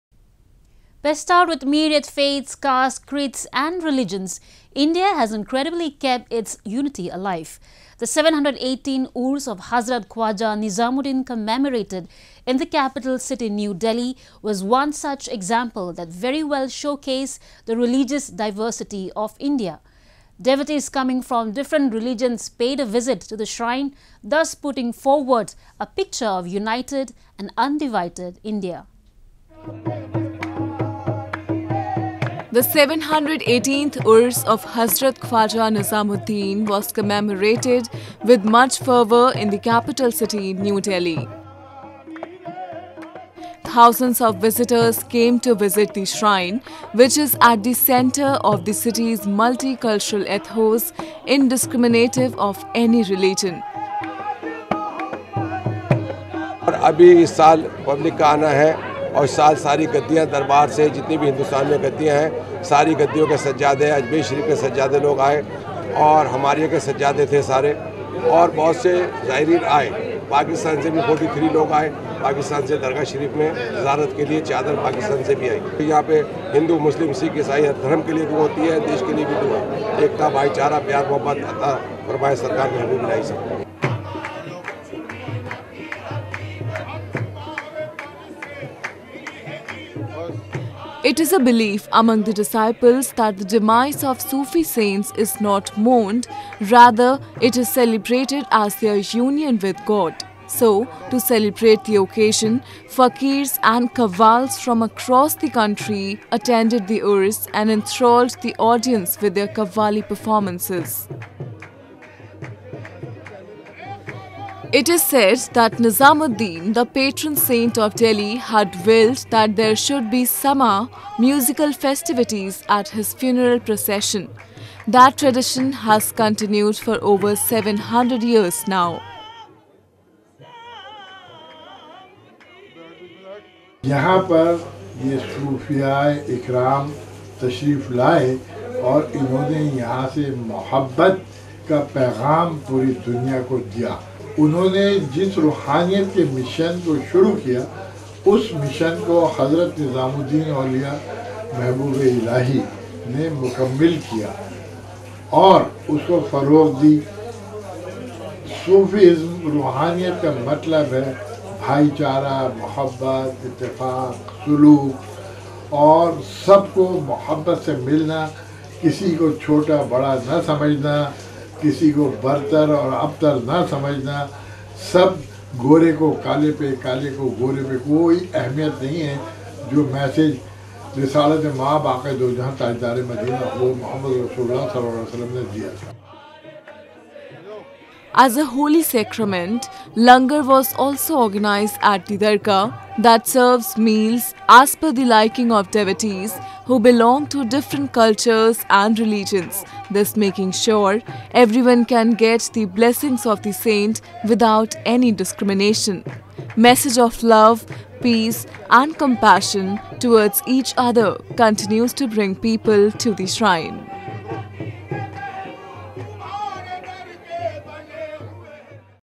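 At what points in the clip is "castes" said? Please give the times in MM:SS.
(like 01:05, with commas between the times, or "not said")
00:02.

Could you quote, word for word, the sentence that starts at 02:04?
That tradition has continued for over 700 years now.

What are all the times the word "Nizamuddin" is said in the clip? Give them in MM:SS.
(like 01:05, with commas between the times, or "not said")
00:10, 00:35, 01:55.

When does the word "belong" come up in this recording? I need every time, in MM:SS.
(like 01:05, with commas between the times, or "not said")
03:16.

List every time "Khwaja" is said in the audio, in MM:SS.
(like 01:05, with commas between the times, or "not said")
00:10, 00:35.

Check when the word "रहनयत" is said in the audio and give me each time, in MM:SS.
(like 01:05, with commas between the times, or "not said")
02:25, 02:39.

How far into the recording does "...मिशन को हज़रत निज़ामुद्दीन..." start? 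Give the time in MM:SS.
02:28.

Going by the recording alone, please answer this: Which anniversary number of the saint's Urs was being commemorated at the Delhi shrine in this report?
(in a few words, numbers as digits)
718th.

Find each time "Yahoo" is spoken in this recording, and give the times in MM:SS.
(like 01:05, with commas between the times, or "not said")
not said.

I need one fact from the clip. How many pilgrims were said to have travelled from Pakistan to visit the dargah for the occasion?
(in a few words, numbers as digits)
43.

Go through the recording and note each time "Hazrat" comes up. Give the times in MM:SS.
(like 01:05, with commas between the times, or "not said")
00:09, 00:34.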